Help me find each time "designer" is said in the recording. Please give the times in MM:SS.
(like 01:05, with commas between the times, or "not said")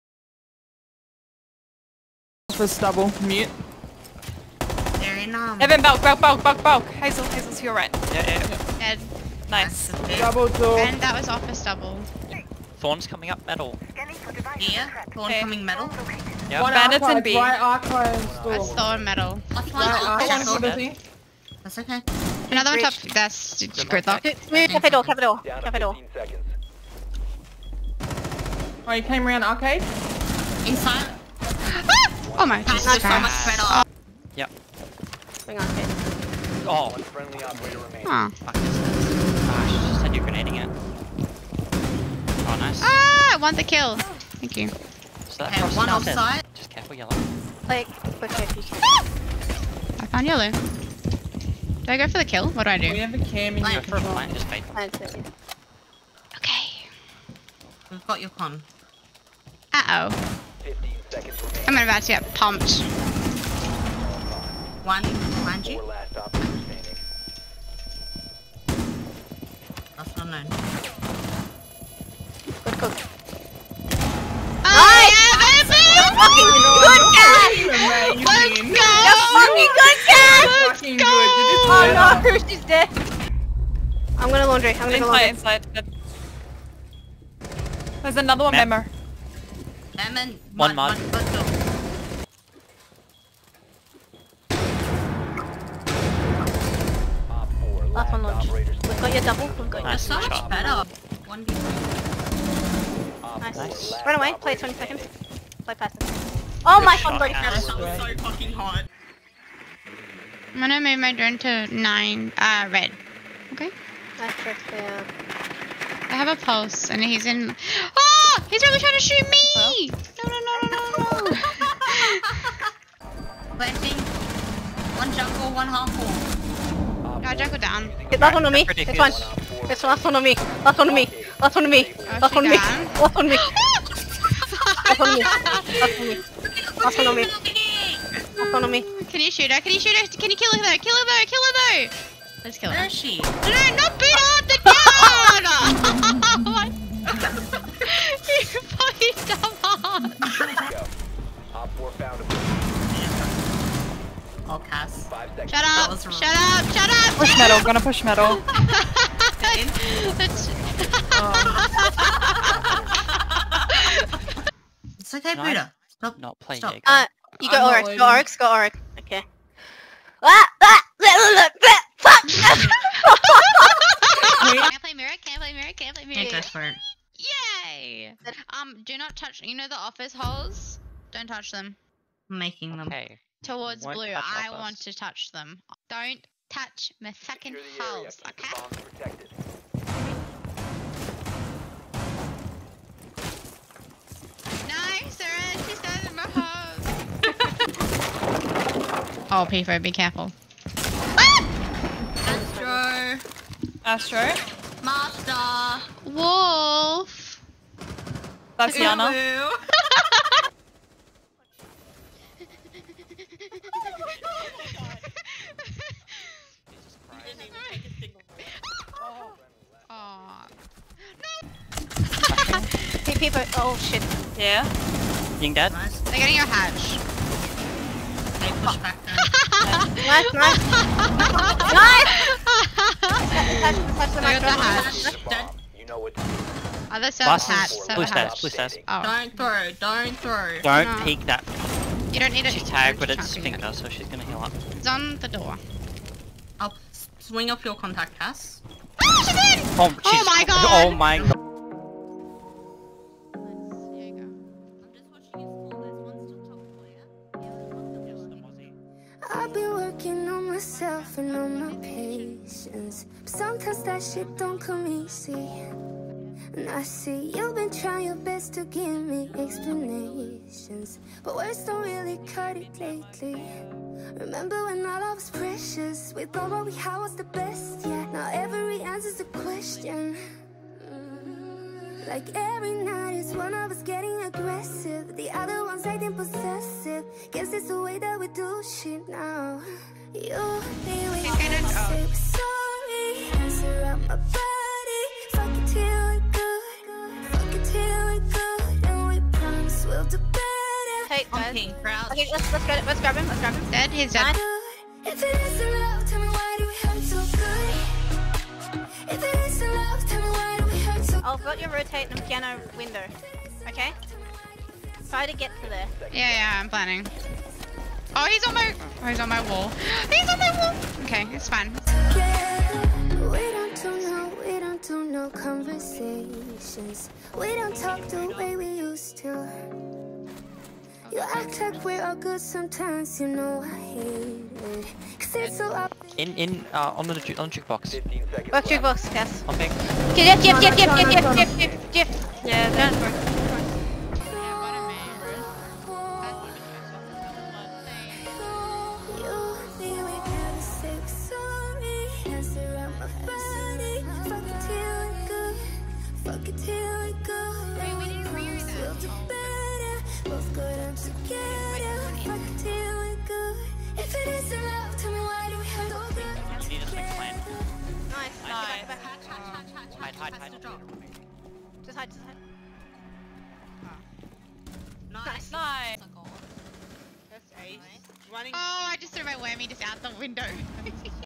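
not said.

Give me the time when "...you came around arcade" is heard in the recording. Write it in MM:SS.
00:28.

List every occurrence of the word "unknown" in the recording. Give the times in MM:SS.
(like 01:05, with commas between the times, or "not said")
01:10.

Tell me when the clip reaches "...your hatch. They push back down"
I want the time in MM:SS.
03:46.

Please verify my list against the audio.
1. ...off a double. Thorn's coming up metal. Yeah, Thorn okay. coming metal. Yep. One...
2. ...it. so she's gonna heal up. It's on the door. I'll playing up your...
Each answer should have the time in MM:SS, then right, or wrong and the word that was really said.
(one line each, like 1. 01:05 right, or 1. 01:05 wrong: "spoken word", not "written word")
1. 00:11 wrong: "stubble", not "double"
2. 04:03 wrong: "swing", not "playing".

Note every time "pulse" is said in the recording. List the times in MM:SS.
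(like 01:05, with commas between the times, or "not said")
01:56.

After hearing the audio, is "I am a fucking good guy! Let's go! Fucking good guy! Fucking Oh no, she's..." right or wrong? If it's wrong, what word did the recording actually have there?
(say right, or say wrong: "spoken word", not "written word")
right.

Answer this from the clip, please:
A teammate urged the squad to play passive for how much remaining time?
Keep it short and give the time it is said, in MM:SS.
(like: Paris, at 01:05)
20 seconds, at 01:44.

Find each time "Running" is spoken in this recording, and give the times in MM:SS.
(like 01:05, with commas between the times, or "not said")
06:18.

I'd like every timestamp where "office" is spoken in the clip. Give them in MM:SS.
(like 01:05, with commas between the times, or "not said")
02:59.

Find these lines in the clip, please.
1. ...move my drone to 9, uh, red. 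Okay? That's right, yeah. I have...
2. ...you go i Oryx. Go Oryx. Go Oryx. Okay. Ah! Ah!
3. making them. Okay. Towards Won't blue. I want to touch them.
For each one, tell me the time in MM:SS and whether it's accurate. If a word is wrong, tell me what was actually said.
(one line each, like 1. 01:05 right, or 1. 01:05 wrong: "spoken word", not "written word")
1. 01:50 right
2. 02:47 right
3. 03:02 right.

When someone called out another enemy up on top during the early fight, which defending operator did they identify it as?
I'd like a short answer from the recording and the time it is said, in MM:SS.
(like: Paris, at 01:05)
Gridlock, at 00:23.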